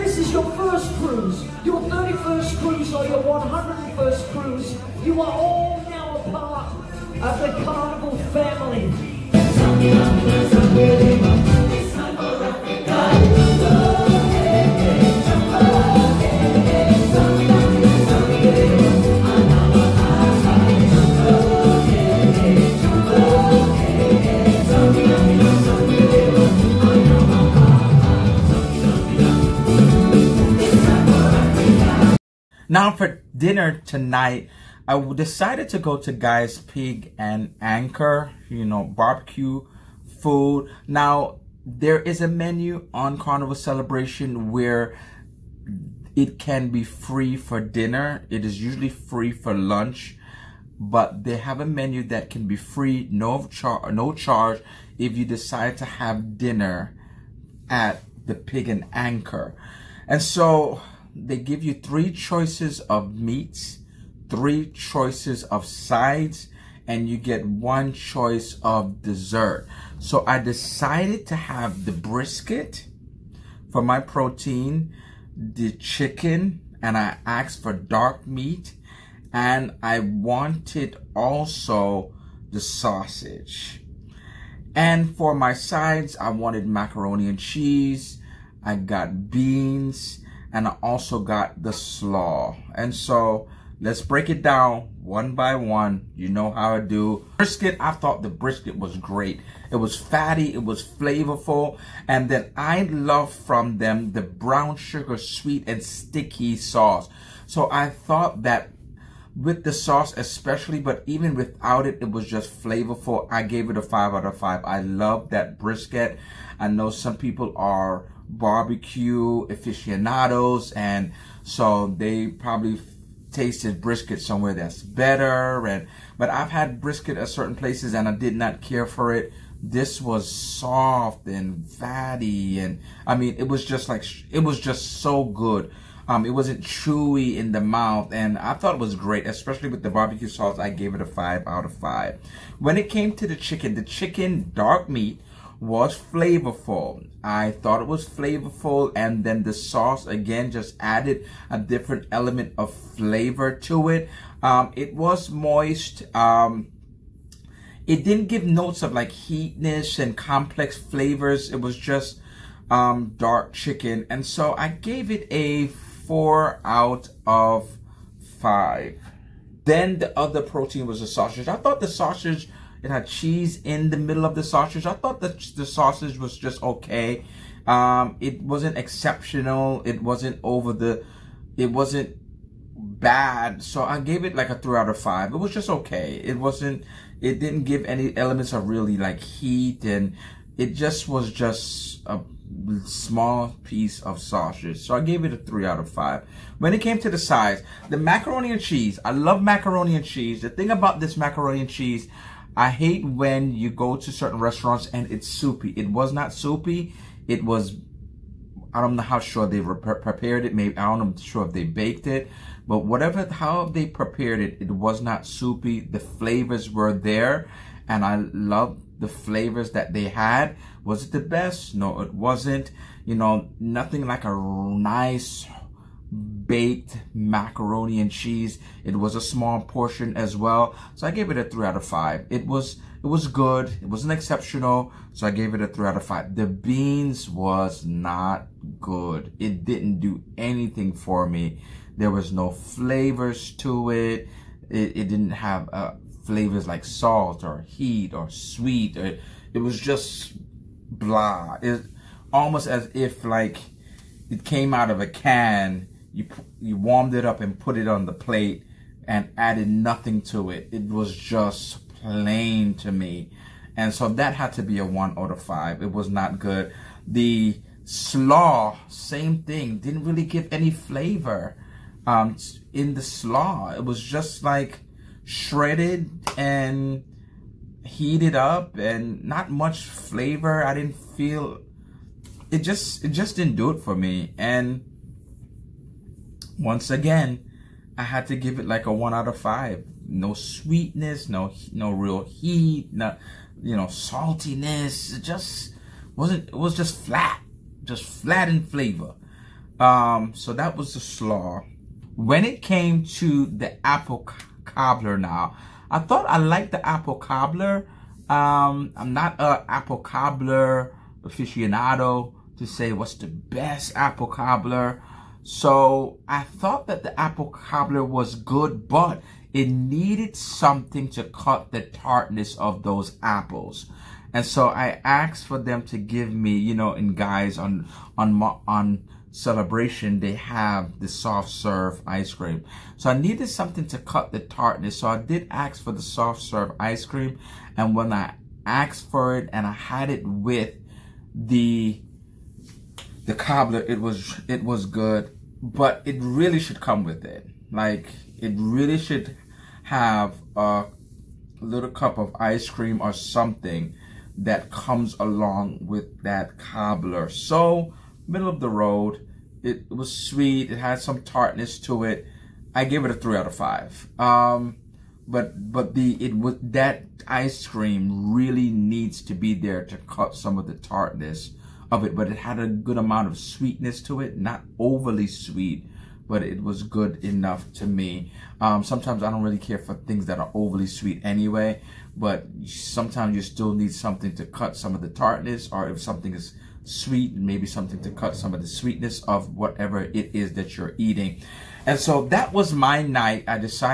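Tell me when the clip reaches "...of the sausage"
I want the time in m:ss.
2:54.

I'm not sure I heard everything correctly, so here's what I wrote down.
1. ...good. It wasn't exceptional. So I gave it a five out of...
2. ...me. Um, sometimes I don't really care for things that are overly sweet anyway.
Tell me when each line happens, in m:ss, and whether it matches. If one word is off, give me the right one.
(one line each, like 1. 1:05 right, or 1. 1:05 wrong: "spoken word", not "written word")
1. 3:53 wrong: "three", not "five"
2. 6:17 right.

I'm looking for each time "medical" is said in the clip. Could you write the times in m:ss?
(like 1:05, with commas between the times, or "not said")
not said.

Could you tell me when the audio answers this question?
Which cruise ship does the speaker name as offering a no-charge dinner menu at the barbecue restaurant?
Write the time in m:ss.
0:43.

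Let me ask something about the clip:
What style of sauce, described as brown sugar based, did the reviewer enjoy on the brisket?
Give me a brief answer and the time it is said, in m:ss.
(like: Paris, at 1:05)
sweet and sticky, at 1:45.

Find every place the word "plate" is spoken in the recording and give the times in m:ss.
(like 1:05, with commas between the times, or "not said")
4:18.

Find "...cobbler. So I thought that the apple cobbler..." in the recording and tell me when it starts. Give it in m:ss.
5:14.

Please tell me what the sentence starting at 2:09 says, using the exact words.
This was soft and fatty, and I mean, it was just like, it was just so good.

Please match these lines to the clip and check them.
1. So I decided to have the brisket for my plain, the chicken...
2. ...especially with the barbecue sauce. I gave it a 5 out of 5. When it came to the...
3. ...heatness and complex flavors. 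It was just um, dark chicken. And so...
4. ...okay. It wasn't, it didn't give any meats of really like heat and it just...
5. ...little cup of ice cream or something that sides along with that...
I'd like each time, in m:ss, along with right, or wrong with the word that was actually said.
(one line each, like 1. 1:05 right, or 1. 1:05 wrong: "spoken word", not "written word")
1. 1:09 wrong: "protein", not "plain"
2. 2:19 right
3. 2:39 right
4. 3:05 wrong: "elements", not "meats"
5. 5:51 wrong: "comes", not "sides".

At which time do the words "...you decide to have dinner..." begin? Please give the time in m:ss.
0:55.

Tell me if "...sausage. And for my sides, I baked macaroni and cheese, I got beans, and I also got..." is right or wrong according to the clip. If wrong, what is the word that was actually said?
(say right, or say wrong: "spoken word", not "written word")
wrong: "wanted", not "baked".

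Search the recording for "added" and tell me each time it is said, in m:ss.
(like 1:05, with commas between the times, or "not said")
2:30, 4:19.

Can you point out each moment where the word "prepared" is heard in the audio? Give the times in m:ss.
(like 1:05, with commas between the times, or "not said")
3:29, 3:33.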